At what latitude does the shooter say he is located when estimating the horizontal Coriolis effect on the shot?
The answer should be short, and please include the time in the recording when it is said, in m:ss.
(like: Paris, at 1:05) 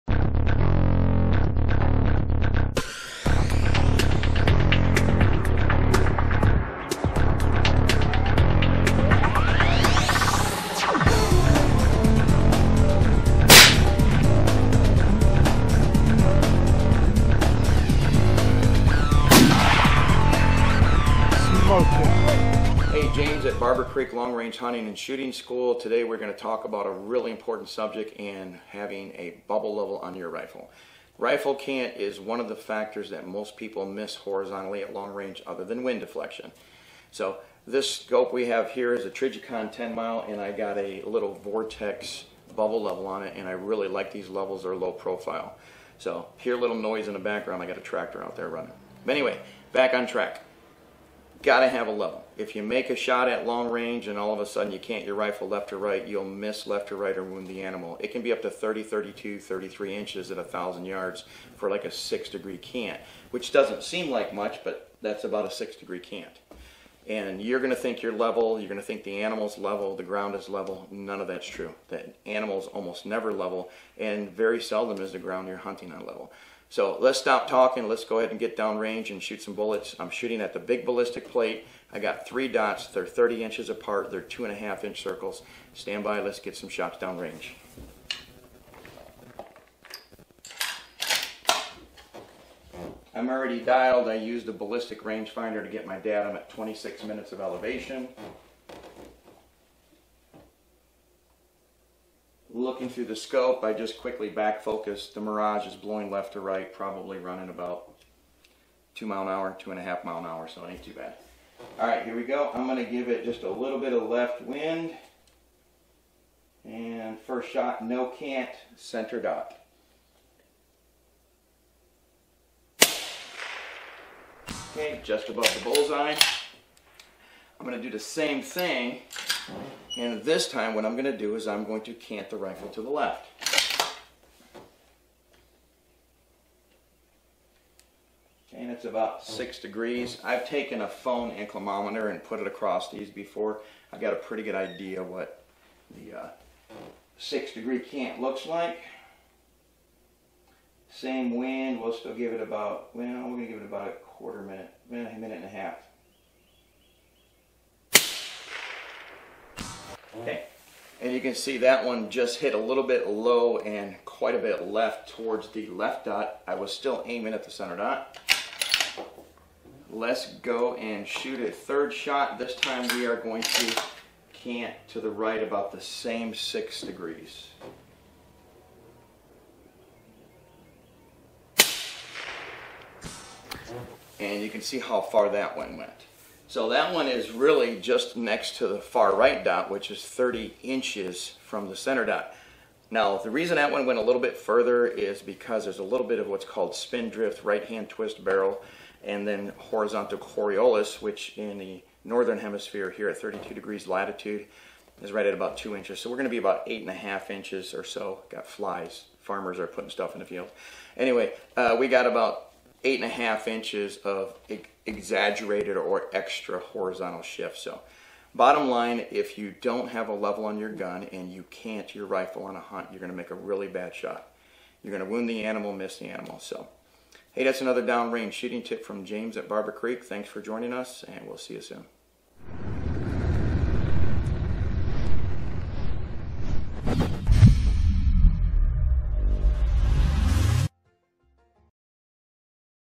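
32 degrees, at 3:23.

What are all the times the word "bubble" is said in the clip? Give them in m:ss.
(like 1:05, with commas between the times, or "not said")
0:29, 0:42.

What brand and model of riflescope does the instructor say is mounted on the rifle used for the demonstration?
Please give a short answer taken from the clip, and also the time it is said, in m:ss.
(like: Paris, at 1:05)
Trijicon 10 mile, at 0:39.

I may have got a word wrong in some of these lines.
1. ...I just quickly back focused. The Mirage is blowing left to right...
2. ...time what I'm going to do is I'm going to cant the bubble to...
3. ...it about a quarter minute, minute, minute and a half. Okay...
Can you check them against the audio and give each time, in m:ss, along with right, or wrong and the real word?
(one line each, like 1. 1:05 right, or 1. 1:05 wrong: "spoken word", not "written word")
1. 1:43 right
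2. 2:10 wrong: "rifle", not "bubble"
3. 2:33 right.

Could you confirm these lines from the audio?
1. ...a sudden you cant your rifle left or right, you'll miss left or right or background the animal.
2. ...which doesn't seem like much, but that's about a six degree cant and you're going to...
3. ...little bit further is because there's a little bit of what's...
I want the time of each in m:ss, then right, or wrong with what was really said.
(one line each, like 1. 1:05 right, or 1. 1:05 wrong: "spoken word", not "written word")
1. 0:54 wrong: "wound", not "background"
2. 1:03 right
3. 3:14 right.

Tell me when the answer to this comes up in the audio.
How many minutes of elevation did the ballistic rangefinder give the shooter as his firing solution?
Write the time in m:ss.
1:36.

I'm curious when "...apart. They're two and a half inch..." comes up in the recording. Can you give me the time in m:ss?
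1:23.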